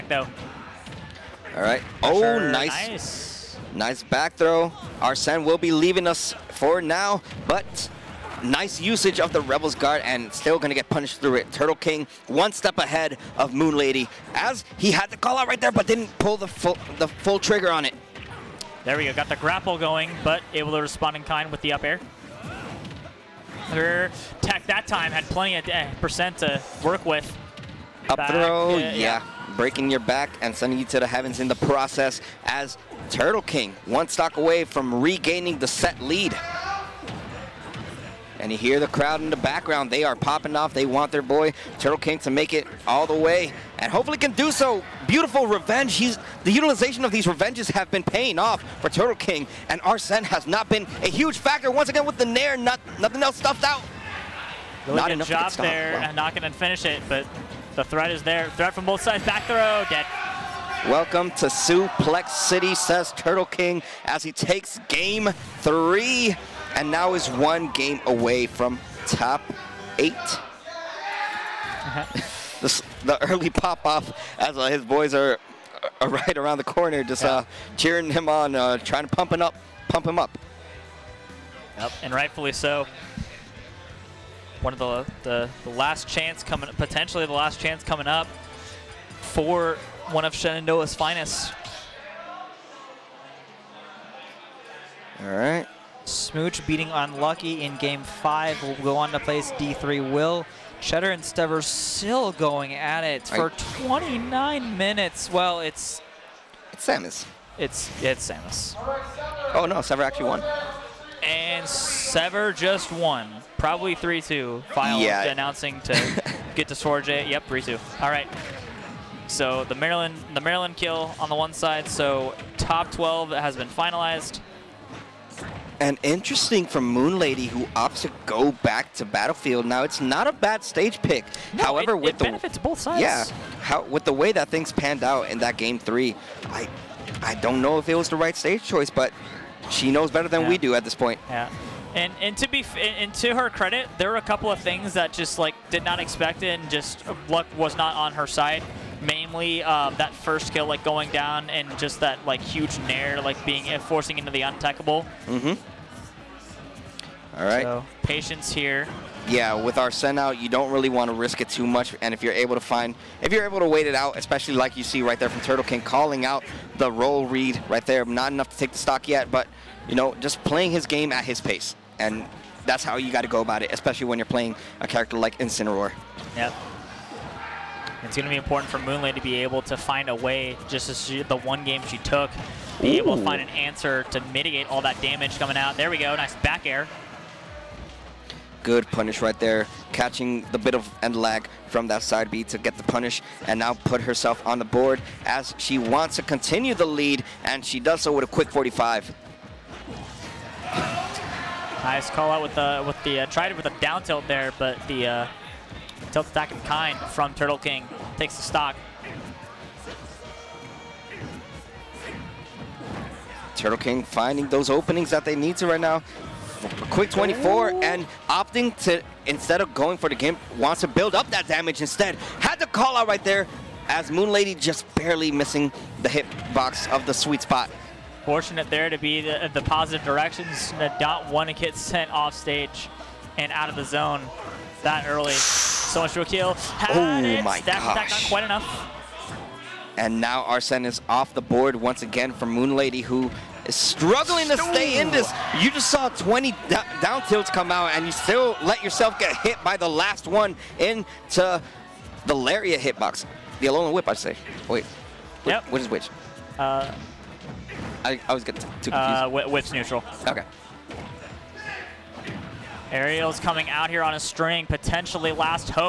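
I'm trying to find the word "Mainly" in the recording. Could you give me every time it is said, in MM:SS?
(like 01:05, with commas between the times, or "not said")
02:29.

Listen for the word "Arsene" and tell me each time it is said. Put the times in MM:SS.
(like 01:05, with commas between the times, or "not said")
00:05, 00:49, 02:39, 04:00.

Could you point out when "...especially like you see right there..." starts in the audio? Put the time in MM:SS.
02:44.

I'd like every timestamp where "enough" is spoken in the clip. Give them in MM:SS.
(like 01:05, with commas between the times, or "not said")
00:55, 02:48, 03:58.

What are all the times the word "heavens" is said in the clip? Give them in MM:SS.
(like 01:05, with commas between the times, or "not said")
00:31.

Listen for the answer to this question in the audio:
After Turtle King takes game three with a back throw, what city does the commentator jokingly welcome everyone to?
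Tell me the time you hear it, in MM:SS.
01:01.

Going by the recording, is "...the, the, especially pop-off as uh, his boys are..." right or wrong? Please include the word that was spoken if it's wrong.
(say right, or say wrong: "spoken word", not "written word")
wrong: "early", not "especially".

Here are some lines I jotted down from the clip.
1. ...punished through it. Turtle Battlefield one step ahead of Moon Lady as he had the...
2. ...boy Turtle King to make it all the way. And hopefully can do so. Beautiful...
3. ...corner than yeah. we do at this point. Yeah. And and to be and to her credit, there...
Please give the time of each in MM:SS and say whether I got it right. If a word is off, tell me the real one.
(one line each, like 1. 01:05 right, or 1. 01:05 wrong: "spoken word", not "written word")
1. 00:10 wrong: "King", not "Battlefield"
2. 00:41 right
3. 02:20 wrong: "better", not "corner".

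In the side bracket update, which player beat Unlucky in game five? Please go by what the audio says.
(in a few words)
Smooch.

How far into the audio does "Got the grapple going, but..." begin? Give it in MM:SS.
00:19.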